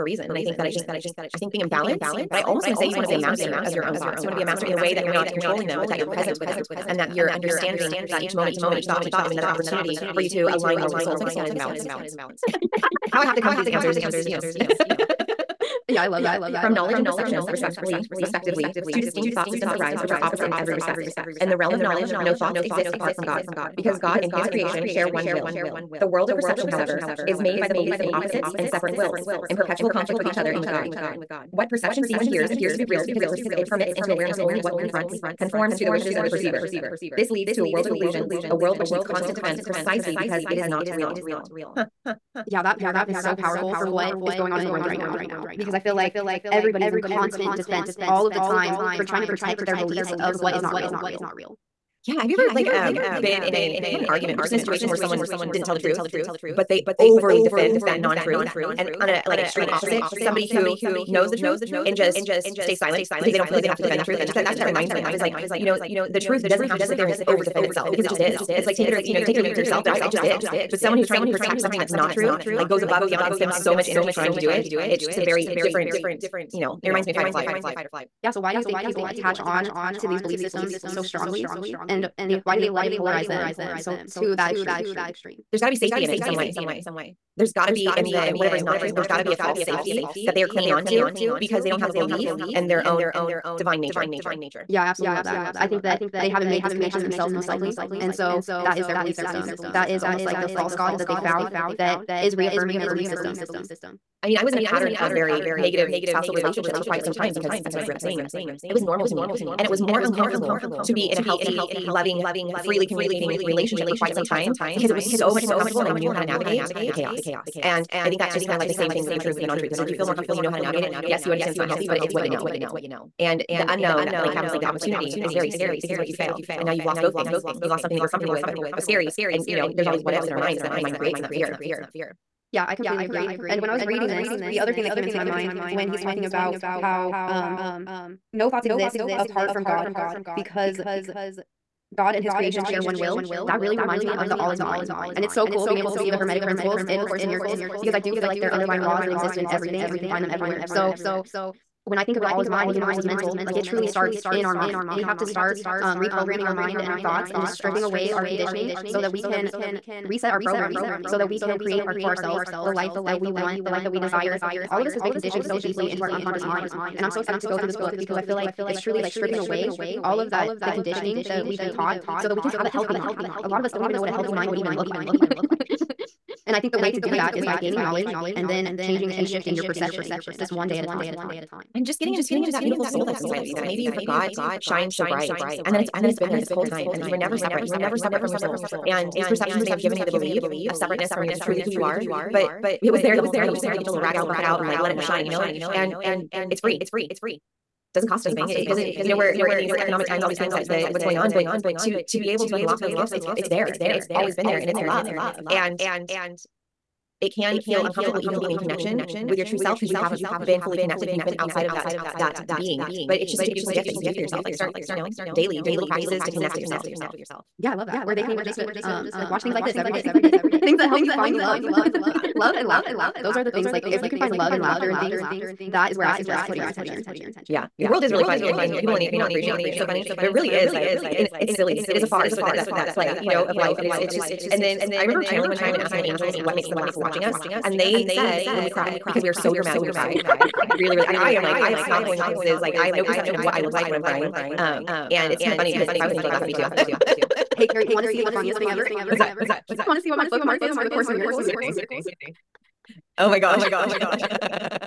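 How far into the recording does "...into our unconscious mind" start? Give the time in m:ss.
2:45.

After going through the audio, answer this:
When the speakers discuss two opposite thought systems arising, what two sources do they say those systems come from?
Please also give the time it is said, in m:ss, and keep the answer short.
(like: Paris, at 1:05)
knowledge and perception, at 0:16.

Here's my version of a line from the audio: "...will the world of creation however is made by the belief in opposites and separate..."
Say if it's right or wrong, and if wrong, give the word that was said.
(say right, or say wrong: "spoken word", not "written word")
wrong: "perception", not "creation".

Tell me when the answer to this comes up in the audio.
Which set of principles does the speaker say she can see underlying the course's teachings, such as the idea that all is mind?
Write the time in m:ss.
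2:26.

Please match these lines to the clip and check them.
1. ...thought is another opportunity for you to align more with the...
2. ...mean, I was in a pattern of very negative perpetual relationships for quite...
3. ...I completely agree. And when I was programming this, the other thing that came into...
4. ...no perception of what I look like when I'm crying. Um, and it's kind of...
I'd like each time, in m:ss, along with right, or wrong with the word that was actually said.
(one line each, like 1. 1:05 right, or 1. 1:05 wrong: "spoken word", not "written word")
1. 0:09 right
2. 1:44 wrong: "spousal", not "perpetual"
3. 2:12 wrong: "reading", not "programming"
4. 4:02 right.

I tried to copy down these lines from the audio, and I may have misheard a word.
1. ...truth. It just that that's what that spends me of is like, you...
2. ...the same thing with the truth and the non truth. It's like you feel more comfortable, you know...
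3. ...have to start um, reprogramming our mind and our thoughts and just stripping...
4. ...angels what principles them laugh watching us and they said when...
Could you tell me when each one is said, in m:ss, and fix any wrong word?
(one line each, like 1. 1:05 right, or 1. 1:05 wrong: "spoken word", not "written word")
1. 1:04 wrong: "reminds", not "spends"
2. 1:58 right
3. 2:35 right
4. 3:56 wrong: "makes", not "principles".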